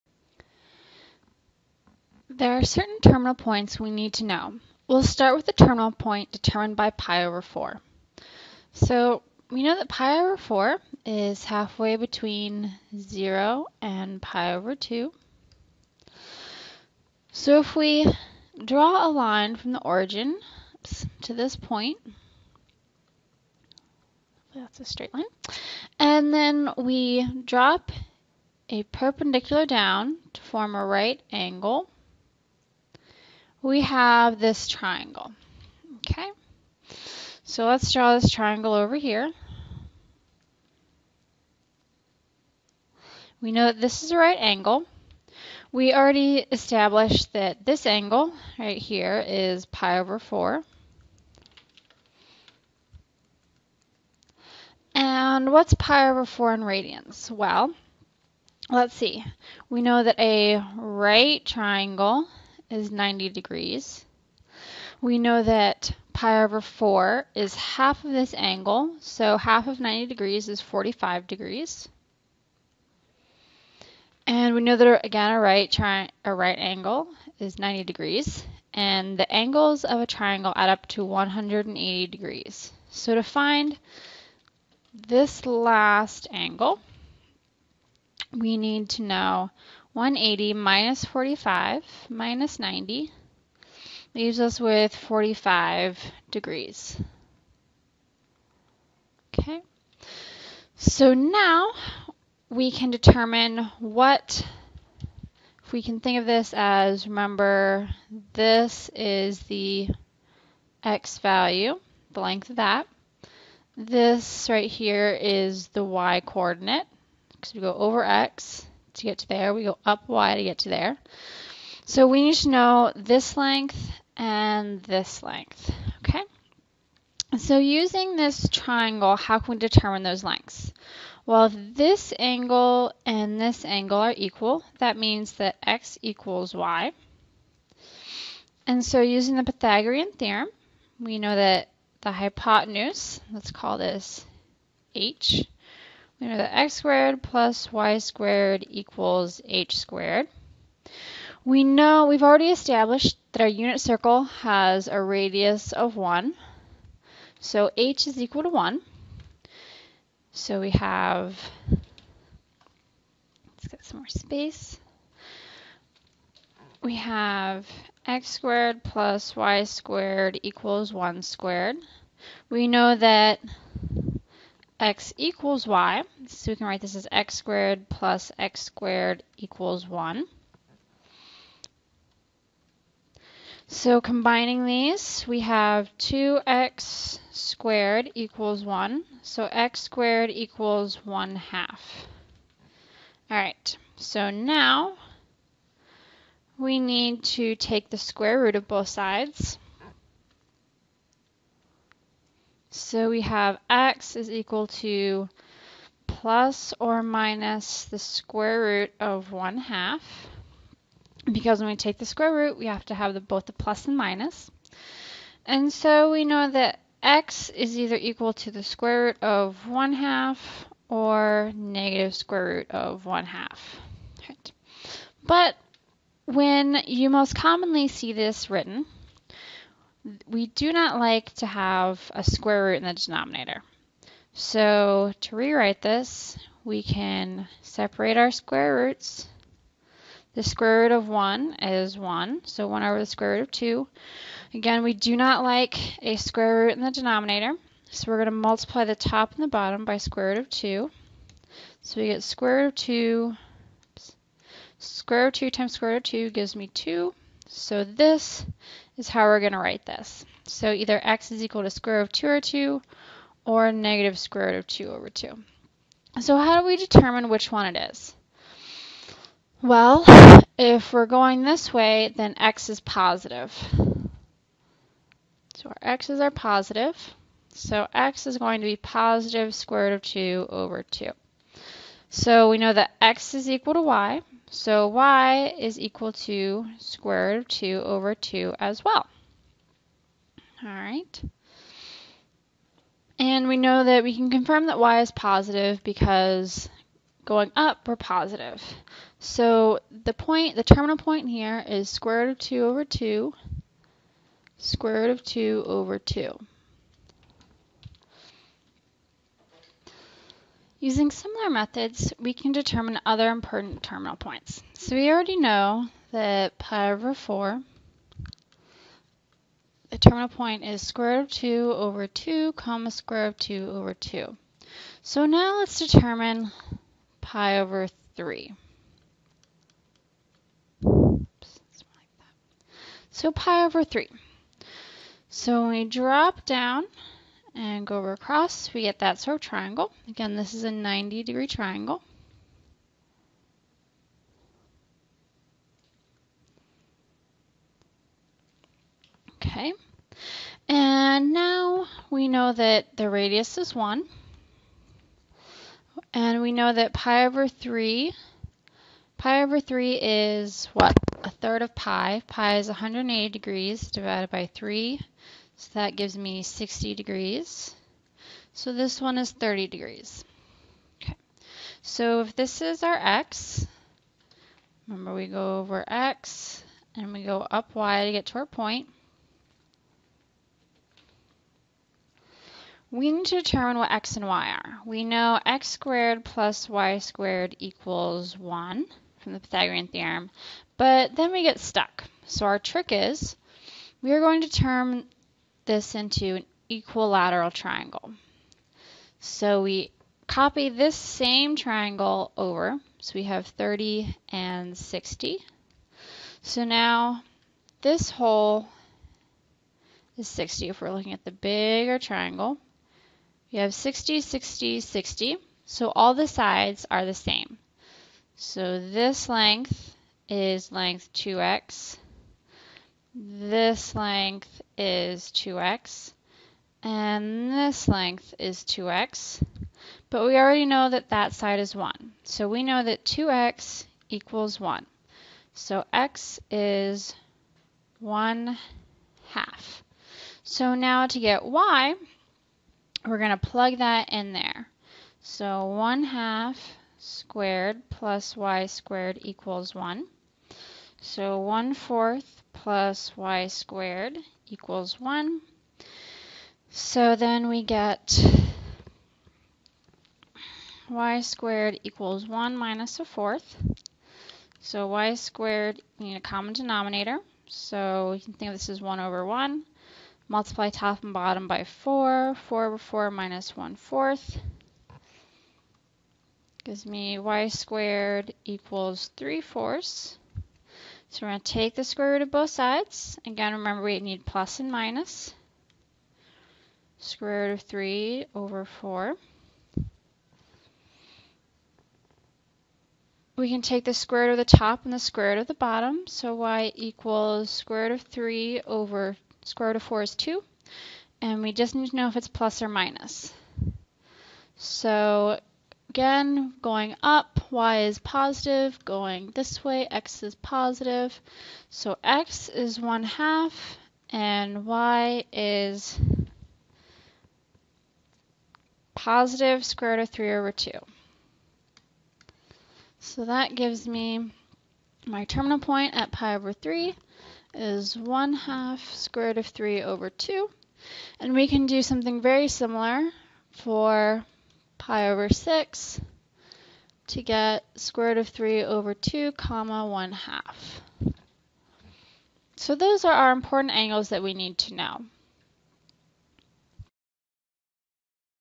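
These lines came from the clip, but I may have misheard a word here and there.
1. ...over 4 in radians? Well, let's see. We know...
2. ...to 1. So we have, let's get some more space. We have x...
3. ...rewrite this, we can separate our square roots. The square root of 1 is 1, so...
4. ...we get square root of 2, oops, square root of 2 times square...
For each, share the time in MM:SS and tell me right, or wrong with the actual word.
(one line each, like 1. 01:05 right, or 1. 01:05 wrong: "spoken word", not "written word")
1. 00:56 right
2. 02:38 right
3. 03:55 right
4. 04:12 right.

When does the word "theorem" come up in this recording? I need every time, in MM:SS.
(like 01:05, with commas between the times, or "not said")
02:20, 06:29.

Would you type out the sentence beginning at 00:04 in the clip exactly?
We'll start with the terminal point determined by pi over 4.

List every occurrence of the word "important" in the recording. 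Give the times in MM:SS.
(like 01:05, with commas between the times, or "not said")
05:13, 09:03.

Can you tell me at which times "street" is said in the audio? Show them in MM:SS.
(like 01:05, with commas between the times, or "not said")
not said.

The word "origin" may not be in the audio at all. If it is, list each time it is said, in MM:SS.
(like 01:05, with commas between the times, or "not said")
00:19.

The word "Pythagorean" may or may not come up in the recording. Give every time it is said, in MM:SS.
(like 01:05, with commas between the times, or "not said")
02:19, 06:29.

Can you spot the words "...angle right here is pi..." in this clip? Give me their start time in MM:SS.
00:47.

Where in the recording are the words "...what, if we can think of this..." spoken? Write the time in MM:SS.
01:43.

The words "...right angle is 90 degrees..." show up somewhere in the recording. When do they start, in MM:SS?
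01:16.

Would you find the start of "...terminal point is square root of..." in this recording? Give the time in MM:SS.
05:19.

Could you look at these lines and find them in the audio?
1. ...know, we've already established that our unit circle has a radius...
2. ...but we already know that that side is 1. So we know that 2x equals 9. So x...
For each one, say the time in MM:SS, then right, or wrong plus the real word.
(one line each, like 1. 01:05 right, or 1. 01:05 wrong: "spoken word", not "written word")
1. 02:31 right
2. 07:10 wrong: "1", not "9".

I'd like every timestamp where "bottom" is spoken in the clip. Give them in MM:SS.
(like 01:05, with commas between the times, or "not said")
04:09, 07:51, 08:15.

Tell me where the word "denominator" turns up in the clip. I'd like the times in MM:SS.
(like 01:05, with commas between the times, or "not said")
03:52, 04:06, 07:46.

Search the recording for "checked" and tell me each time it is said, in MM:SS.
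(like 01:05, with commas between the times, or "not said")
not said.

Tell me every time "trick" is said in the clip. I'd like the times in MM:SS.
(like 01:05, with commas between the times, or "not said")
06:32.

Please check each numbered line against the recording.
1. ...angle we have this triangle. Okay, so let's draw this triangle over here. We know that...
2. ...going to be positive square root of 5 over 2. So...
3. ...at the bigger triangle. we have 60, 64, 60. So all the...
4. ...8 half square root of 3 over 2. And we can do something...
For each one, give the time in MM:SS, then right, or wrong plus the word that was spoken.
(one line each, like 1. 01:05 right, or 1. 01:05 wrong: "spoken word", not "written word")
1. 00:31 right
2. 04:38 wrong: "2", not "5"
3. 06:51 wrong: "60", not "64"
4. 08:47 wrong: "1", not "8".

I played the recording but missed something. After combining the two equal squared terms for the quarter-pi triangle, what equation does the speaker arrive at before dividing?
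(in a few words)
2x squared equals 1.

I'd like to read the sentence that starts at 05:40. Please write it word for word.
Again, this is a 90 degree triangle.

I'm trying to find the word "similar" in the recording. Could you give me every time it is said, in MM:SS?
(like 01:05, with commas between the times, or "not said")
05:11, 08:52.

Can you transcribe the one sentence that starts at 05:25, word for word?
So now let's determine pi over 3.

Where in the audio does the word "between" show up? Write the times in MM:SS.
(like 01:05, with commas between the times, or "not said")
00:11.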